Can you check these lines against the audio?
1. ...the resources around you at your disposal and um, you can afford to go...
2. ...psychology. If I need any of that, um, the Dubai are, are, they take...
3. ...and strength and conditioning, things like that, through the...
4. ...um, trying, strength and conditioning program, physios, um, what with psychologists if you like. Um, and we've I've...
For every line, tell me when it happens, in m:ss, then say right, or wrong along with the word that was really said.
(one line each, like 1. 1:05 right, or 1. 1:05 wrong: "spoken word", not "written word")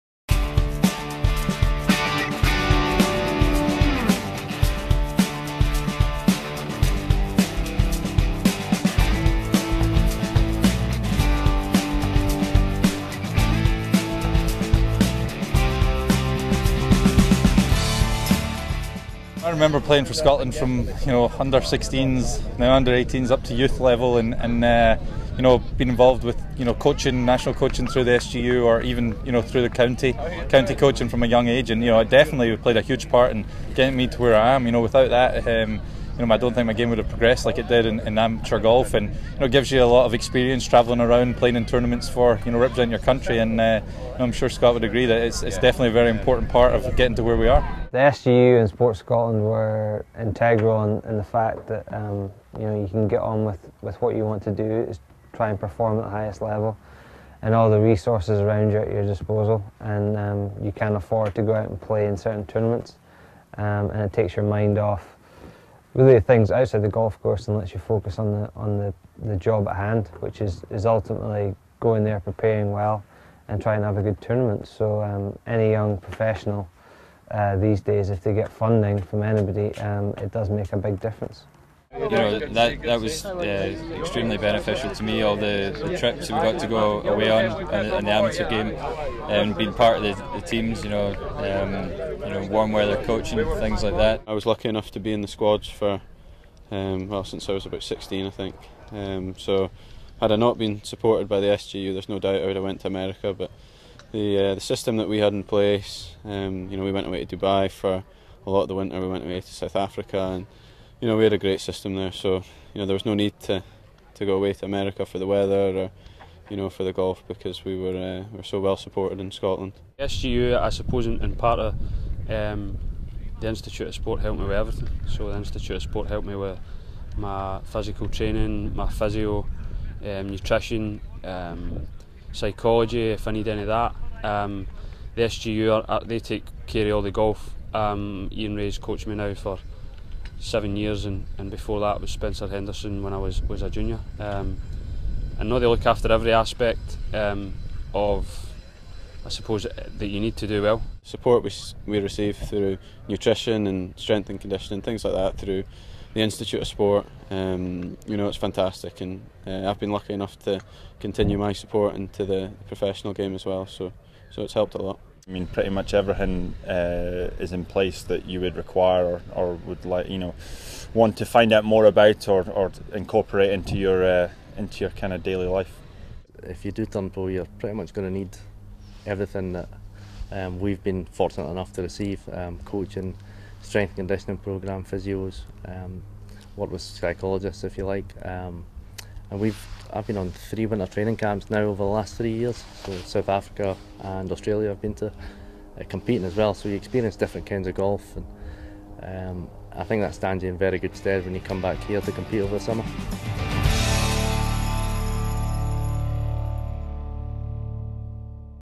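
1. 0:57 right
2. 2:12 wrong: "SGU", not "Dubai"
3. 2:33 right
4. 3:02 wrong: "coaching", not "trying".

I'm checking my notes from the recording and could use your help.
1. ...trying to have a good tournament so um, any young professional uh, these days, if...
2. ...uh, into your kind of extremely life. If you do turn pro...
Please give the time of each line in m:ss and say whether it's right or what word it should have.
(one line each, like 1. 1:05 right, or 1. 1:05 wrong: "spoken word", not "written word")
1. 1:13 right
2. 2:54 wrong: "daily", not "extremely".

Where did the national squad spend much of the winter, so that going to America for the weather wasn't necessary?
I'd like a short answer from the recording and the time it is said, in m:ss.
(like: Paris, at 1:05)
Dubai, at 1:47.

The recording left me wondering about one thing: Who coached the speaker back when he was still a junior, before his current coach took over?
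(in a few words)
Spencer Henderson.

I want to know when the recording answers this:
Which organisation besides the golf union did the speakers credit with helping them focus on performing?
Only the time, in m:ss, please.
0:48.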